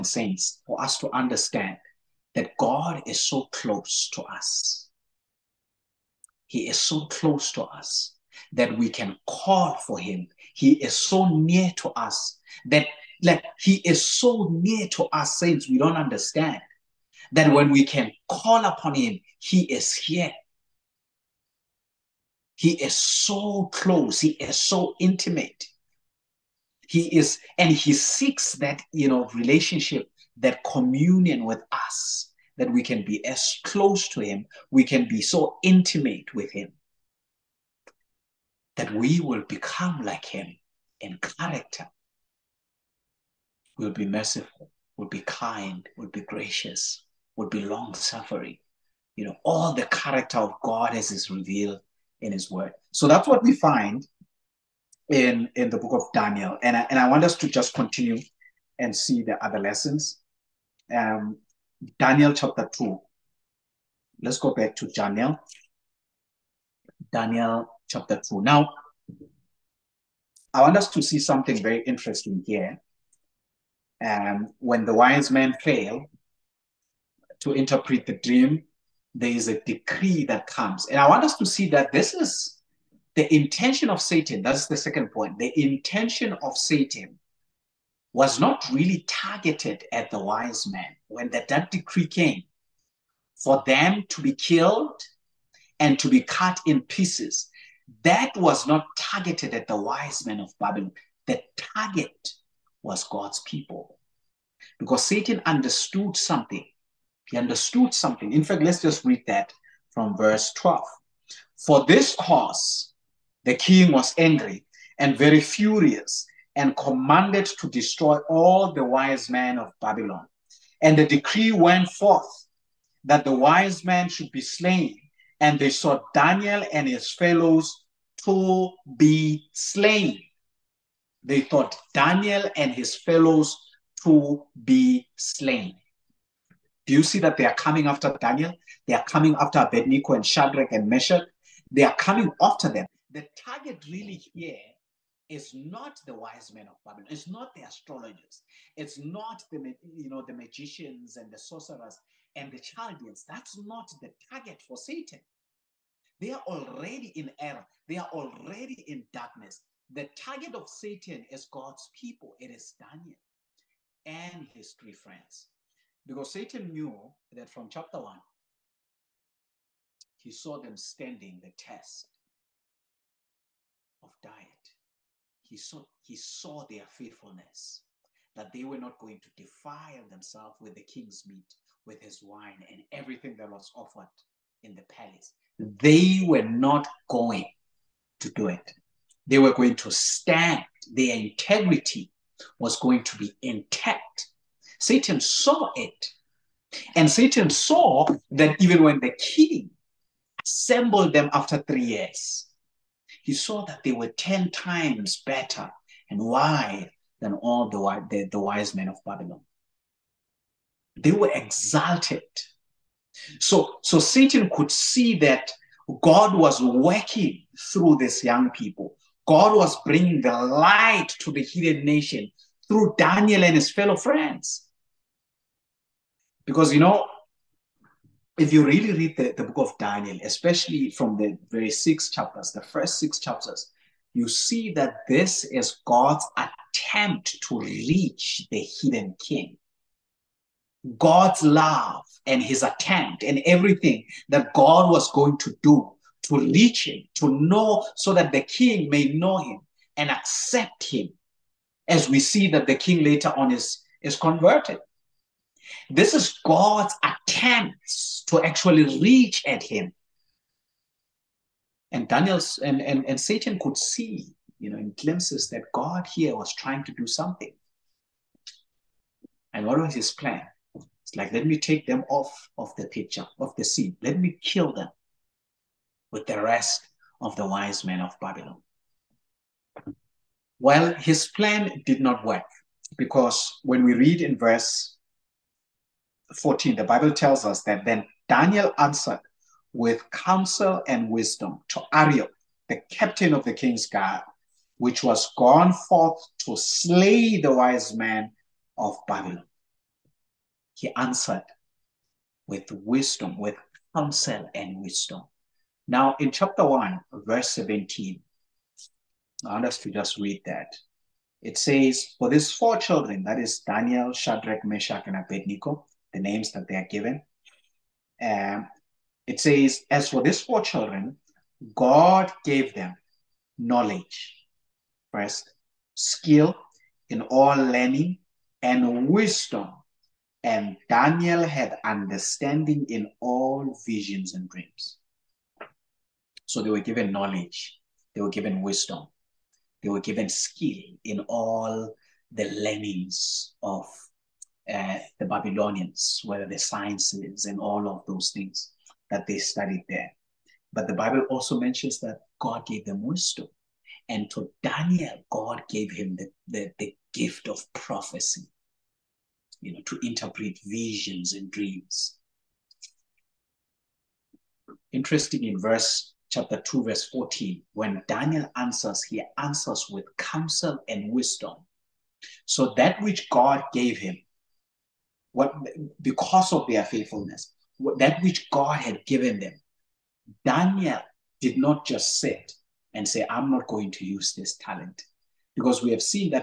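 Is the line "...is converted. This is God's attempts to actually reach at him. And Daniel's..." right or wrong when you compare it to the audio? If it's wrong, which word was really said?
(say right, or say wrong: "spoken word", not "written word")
right.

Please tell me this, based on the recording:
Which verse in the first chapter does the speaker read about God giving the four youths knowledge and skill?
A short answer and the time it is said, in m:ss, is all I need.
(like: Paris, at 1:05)
Verse 17, at 5:07.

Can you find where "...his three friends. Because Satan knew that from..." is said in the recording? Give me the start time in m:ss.
2:44.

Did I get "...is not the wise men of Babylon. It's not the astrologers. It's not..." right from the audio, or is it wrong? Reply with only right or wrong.
right.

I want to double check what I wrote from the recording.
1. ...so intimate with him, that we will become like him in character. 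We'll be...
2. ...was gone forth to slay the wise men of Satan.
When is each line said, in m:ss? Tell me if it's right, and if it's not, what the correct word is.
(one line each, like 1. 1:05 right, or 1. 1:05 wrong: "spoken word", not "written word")
1. 0:35 right
2. 4:55 wrong: "Babylon", not "Satan".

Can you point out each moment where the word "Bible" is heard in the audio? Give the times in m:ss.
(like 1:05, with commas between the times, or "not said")
4:46, 5:50.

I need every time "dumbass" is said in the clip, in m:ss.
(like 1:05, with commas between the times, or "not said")
not said.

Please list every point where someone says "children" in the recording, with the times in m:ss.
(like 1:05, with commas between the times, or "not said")
5:12, 5:20.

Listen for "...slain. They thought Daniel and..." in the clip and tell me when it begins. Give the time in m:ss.
2:09.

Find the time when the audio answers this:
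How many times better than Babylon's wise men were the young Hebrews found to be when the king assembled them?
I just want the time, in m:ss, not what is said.
3:24.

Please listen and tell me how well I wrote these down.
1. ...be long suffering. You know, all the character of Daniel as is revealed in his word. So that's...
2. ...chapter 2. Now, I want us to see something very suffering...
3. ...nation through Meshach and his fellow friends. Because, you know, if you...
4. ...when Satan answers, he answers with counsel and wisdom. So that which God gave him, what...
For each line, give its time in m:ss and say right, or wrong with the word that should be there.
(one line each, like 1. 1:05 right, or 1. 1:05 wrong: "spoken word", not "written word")
1. 0:47 wrong: "God", not "Daniel"
2. 1:07 wrong: "interesting", not "suffering"
3. 3:41 wrong: "Daniel", not "Meshach"
4. 6:07 wrong: "Daniel", not "Satan".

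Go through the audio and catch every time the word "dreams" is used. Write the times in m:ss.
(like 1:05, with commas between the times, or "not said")
1:18, 5:34, 6:01.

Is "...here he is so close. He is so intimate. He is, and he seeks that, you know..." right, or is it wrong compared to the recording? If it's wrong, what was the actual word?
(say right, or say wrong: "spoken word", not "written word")
right.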